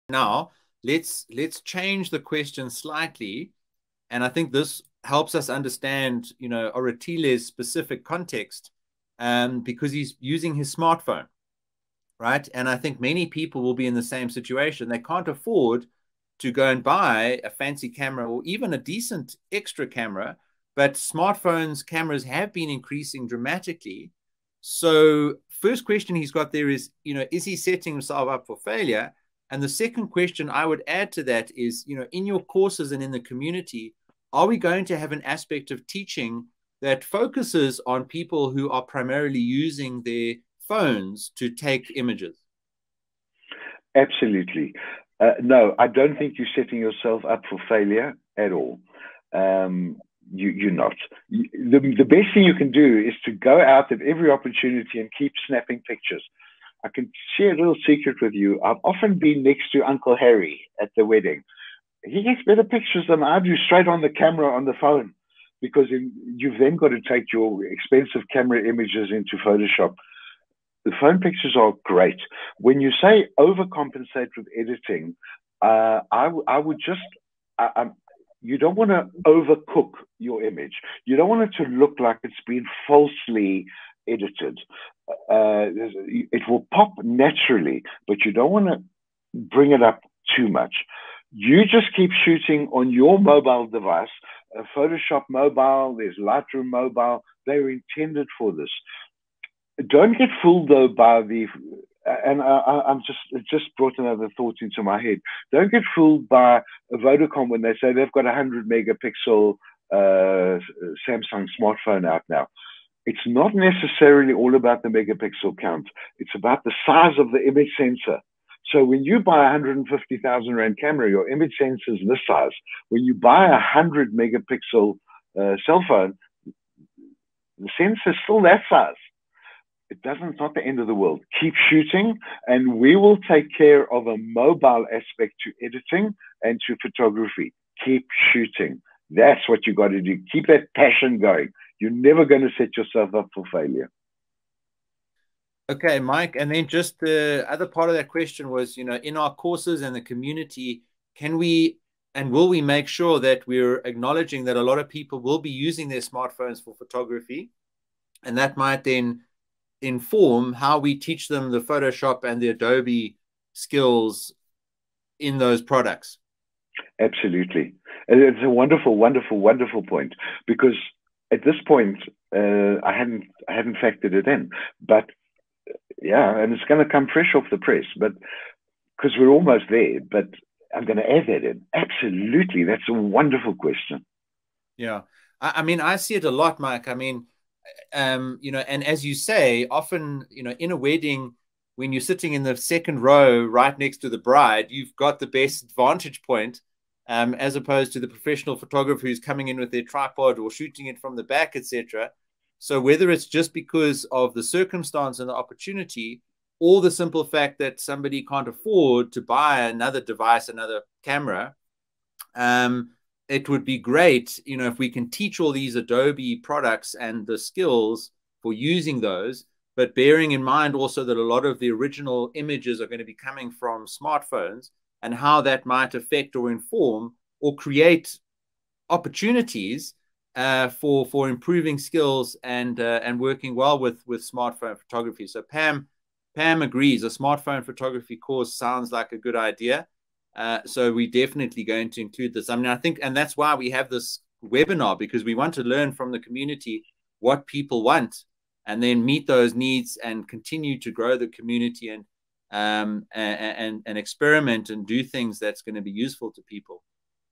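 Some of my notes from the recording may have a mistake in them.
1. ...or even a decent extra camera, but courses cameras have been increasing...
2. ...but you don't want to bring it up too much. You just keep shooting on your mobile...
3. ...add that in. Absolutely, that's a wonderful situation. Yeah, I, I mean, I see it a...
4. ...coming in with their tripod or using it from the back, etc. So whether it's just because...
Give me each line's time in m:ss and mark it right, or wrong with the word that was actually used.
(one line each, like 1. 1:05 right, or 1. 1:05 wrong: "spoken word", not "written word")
1. 0:18 wrong: "smartphones", not "courses"
2. 1:28 right
3. 3:01 wrong: "question", not "situation"
4. 3:19 wrong: "shooting", not "using".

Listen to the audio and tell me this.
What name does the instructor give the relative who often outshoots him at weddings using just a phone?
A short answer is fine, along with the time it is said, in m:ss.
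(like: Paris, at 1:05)
Uncle Harry, at 0:59.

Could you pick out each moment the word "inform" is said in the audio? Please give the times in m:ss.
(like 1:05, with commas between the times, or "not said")
2:39, 3:46.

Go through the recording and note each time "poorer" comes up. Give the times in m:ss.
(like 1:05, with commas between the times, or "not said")
not said.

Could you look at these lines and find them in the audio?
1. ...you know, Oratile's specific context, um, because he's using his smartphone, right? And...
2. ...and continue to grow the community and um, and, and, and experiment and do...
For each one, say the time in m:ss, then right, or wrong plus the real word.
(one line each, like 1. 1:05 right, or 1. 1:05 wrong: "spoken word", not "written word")
1. 0:06 right
2. 4:09 right.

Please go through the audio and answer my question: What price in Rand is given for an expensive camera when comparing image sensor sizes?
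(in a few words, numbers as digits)
150,000 Rand.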